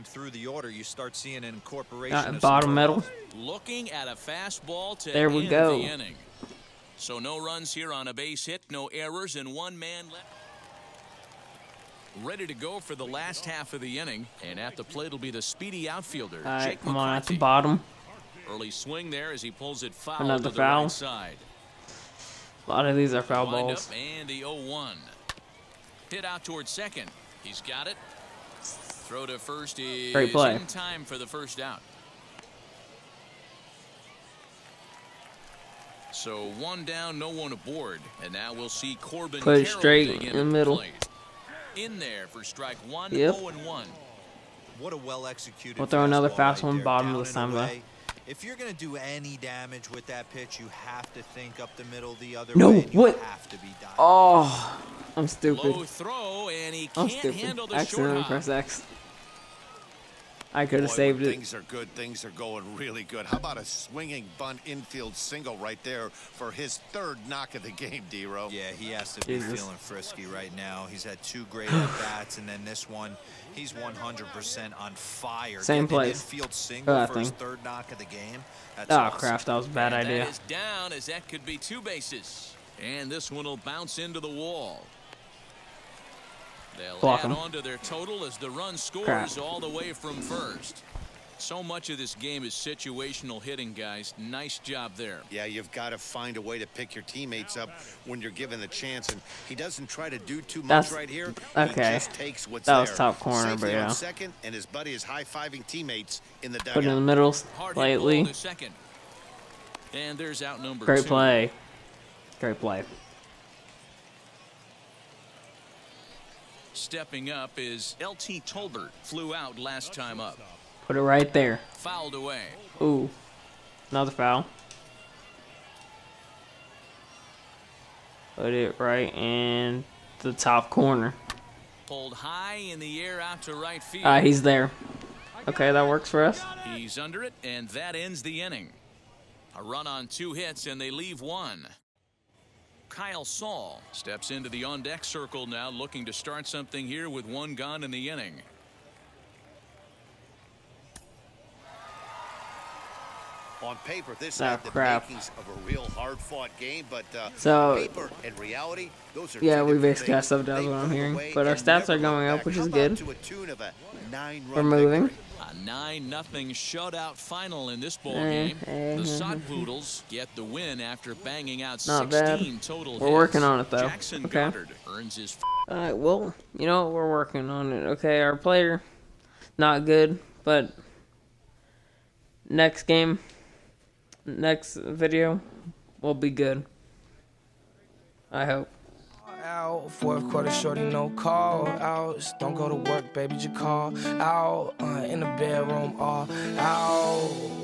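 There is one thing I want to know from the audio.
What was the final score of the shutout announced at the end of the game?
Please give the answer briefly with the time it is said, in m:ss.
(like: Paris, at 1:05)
9-0, at 2:45.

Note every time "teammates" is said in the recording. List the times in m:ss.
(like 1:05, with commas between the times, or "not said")
1:37, 1:45.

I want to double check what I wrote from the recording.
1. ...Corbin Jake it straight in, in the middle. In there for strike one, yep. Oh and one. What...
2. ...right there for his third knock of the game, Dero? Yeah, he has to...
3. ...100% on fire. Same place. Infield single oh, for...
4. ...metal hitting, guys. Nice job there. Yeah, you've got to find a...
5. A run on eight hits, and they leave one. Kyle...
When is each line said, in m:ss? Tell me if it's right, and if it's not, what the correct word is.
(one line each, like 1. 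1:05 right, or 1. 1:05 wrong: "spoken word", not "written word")
1. 0:39 wrong: "Put", not "Jake"
2. 1:05 right
3. 1:13 right
4. 1:32 wrong: "situational", not "metal"
5. 2:19 wrong: "two", not "eight".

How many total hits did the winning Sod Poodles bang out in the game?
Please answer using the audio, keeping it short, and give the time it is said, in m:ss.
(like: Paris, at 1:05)
16, at 2:52.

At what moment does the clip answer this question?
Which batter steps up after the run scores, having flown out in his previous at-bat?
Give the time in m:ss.
1:58.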